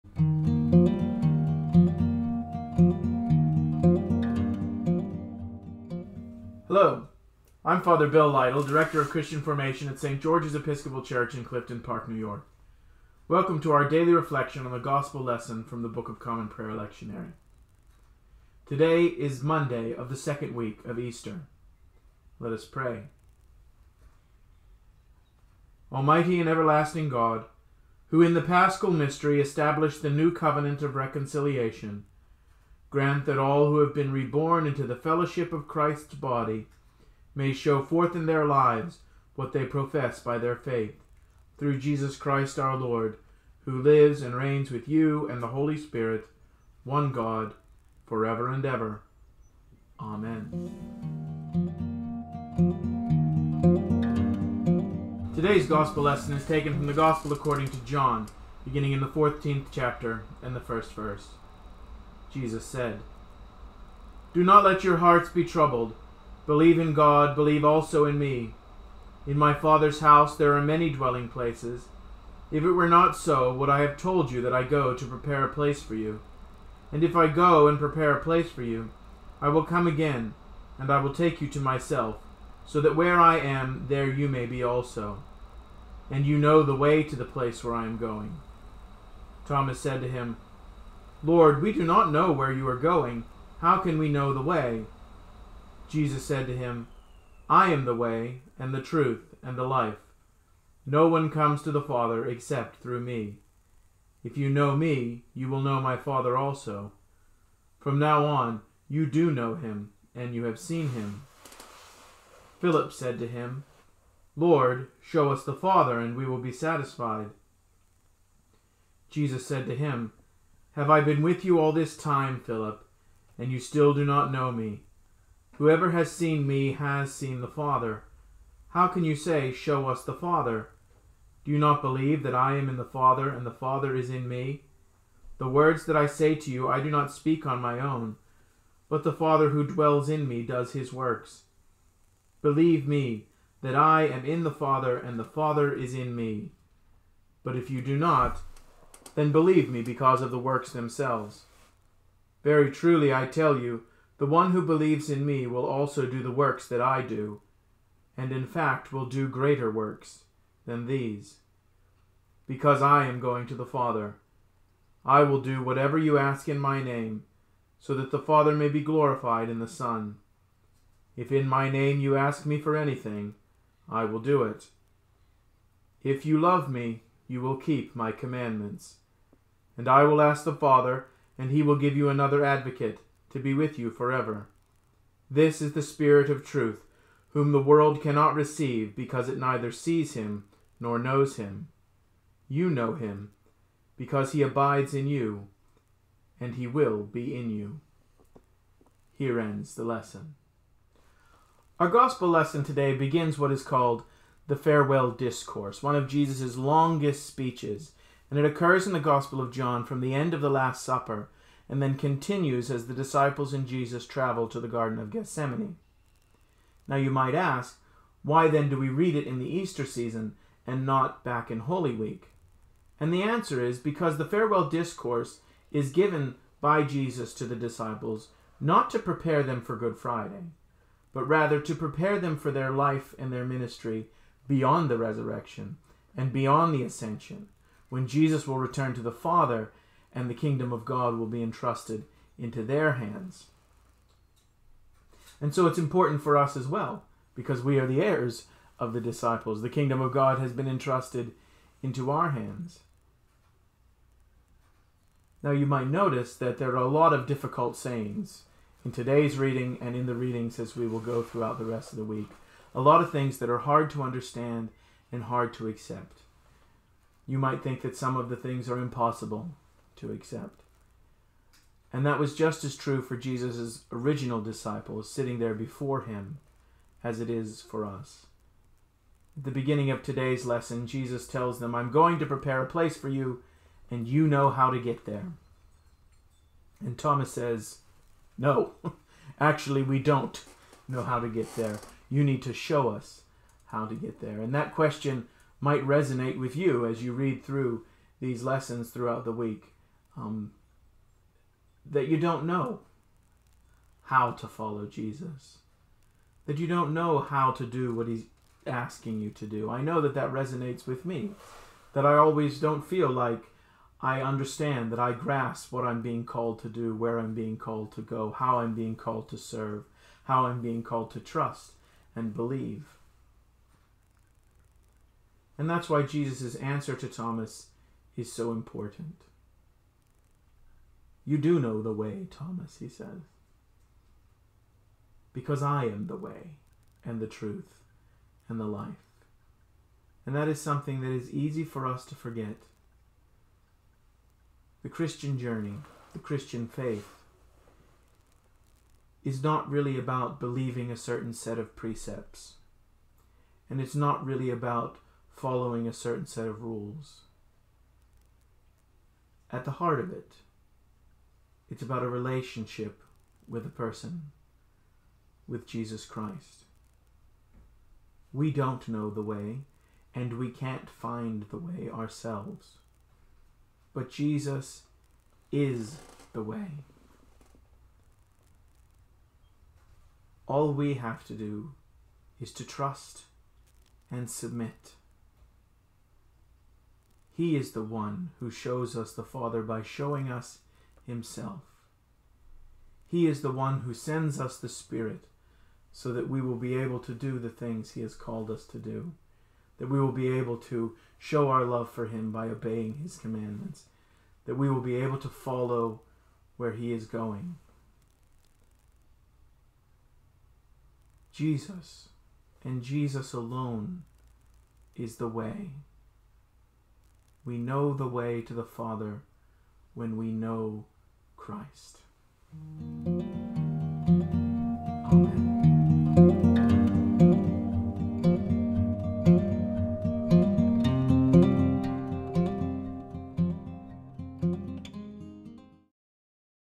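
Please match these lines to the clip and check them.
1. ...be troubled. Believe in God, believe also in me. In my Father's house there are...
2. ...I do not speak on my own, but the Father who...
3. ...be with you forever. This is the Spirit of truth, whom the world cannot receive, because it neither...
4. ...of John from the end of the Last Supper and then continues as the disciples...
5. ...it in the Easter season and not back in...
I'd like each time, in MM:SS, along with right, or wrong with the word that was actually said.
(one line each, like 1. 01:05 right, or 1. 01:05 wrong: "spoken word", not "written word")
1. 01:05 right
2. 02:16 right
3. 03:03 right
4. 03:29 right
5. 03:39 right.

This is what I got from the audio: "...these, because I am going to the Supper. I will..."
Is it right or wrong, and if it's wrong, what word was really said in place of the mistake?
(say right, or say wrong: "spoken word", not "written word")
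wrong: "Father", not "Supper".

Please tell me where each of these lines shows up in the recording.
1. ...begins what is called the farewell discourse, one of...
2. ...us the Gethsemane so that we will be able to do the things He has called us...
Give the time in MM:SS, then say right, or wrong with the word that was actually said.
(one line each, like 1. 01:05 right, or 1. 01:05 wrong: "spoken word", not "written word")
1. 03:22 right
2. 06:34 wrong: "Spirit", not "Gethsemane".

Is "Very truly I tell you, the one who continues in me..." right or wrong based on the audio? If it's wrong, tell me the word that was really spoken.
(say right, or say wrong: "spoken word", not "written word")
wrong: "believes", not "continues".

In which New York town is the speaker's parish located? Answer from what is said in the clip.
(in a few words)
Clifton Park.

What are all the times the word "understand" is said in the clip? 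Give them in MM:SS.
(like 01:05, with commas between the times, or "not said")
04:24, 05:14.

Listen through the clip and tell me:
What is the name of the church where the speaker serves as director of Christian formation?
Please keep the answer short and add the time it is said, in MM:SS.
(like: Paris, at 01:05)
St. George's Episcopal Church, at 00:09.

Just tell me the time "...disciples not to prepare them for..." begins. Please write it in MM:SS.
03:47.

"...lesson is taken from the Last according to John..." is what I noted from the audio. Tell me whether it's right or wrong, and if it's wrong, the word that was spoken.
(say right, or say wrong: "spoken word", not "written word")
wrong: "Gospel", not "Last".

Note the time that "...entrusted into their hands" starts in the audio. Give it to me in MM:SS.
04:01.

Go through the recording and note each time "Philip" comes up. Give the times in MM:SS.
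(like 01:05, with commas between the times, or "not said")
01:52, 02:02.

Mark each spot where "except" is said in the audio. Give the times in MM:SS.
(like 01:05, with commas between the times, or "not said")
01:42.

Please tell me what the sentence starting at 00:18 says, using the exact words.
Today is Monday of the second week of Easter.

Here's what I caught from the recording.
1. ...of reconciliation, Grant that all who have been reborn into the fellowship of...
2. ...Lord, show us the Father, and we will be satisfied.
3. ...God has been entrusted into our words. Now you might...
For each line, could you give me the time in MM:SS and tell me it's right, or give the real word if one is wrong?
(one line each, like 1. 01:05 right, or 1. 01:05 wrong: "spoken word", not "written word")
1. 00:30 right
2. 01:54 right
3. 04:10 wrong: "hands", not "words".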